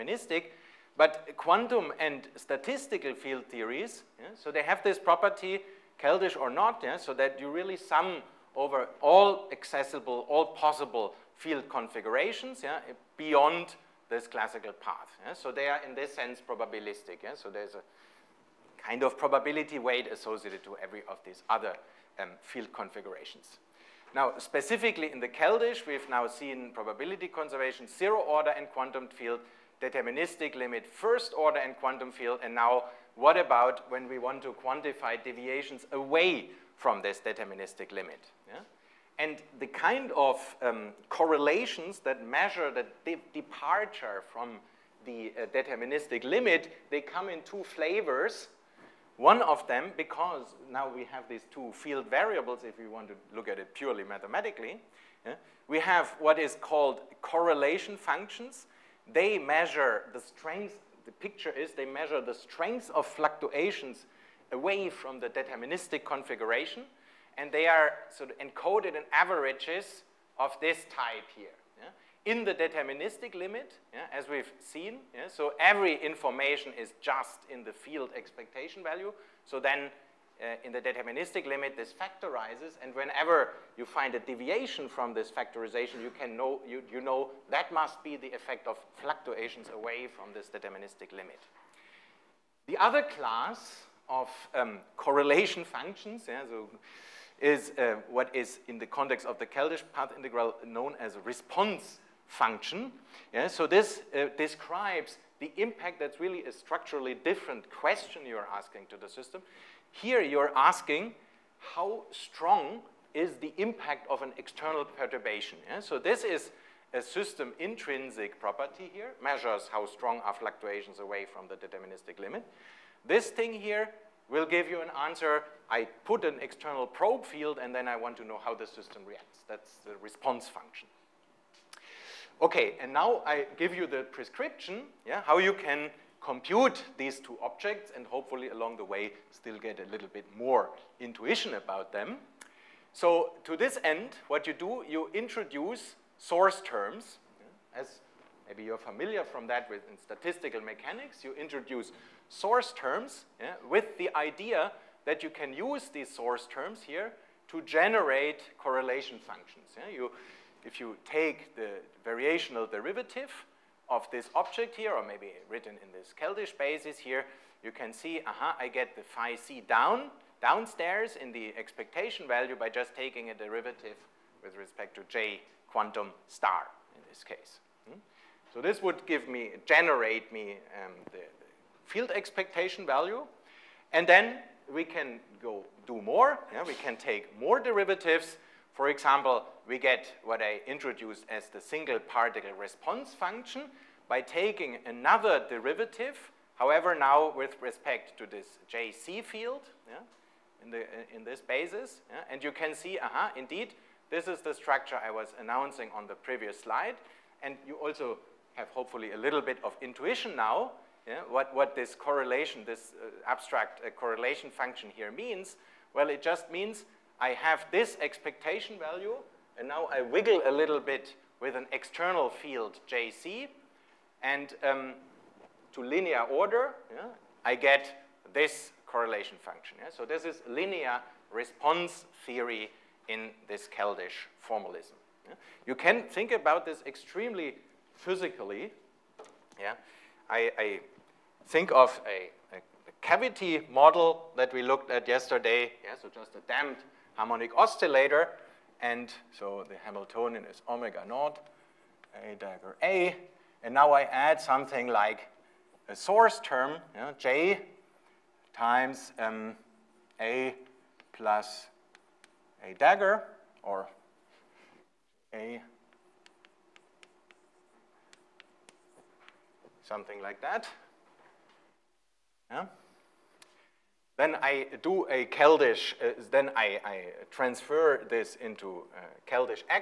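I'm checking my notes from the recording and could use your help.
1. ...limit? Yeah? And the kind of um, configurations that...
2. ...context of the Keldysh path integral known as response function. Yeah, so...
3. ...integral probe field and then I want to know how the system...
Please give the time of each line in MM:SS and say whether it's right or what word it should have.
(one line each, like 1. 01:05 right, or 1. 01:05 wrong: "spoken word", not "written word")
1. 00:37 wrong: "correlations", not "configurations"
2. 01:38 right
3. 02:06 wrong: "external", not "integral".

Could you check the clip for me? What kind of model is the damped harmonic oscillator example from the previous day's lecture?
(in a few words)
Cavity model.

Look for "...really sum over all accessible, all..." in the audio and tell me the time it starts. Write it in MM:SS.
00:07.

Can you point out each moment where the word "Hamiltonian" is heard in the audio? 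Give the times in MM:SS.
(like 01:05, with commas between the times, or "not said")
04:09.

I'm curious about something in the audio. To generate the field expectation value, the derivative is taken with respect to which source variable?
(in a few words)
J quantum star.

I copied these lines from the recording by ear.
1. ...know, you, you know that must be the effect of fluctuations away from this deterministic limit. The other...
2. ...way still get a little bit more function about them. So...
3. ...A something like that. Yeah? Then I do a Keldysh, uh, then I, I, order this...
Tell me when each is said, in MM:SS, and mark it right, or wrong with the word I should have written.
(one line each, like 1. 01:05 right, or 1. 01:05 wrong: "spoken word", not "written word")
1. 01:26 right
2. 02:18 wrong: "intuition", not "function"
3. 04:25 wrong: "transfer", not "order".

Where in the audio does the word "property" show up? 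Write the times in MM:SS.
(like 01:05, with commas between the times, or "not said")
00:04, 01:58.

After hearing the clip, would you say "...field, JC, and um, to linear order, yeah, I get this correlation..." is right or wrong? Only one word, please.
right.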